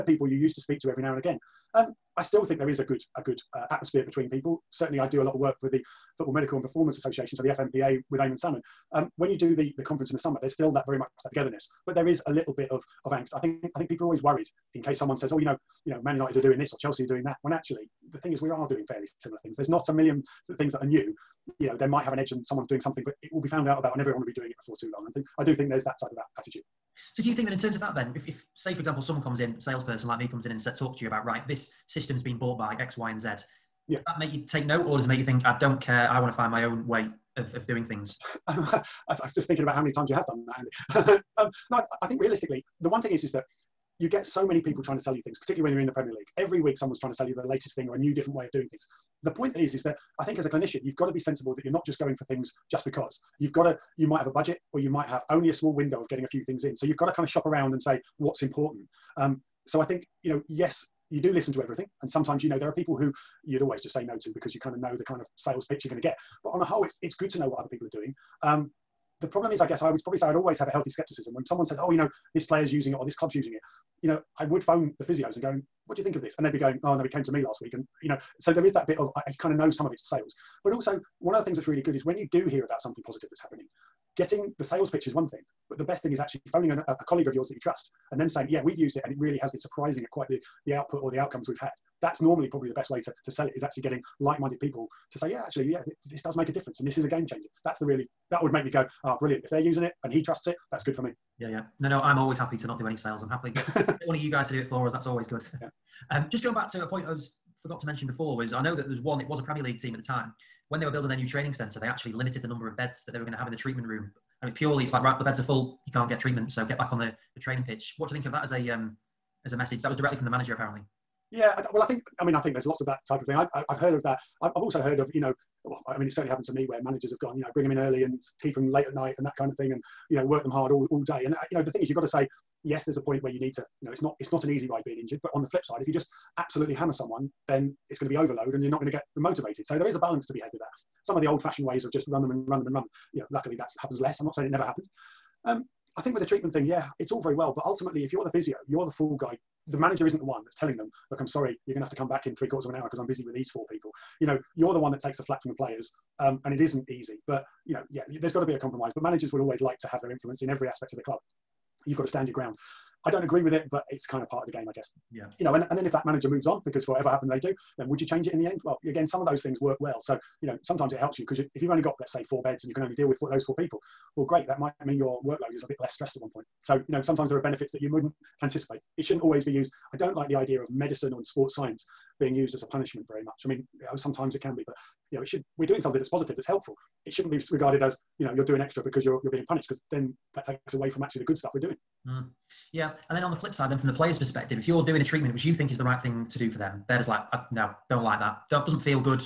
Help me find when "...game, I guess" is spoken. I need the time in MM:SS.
02:44.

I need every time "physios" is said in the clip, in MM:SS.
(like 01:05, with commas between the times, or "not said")
01:15, 02:28.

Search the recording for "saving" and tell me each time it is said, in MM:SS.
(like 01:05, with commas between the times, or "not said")
not said.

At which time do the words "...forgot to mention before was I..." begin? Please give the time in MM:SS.
01:47.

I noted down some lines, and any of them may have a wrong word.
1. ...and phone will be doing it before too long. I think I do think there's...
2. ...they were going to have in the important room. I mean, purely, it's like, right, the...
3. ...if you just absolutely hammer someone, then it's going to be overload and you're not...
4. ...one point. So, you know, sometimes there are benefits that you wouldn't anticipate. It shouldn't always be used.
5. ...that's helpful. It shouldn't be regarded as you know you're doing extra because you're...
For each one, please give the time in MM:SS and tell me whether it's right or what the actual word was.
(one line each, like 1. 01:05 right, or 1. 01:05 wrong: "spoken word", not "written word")
1. 00:23 wrong: "everyone", not "phone"
2. 01:53 wrong: "treatment", not "important"
3. 02:15 right
4. 02:56 right
5. 03:06 right.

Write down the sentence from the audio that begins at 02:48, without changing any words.
Well, again, some of those things work well.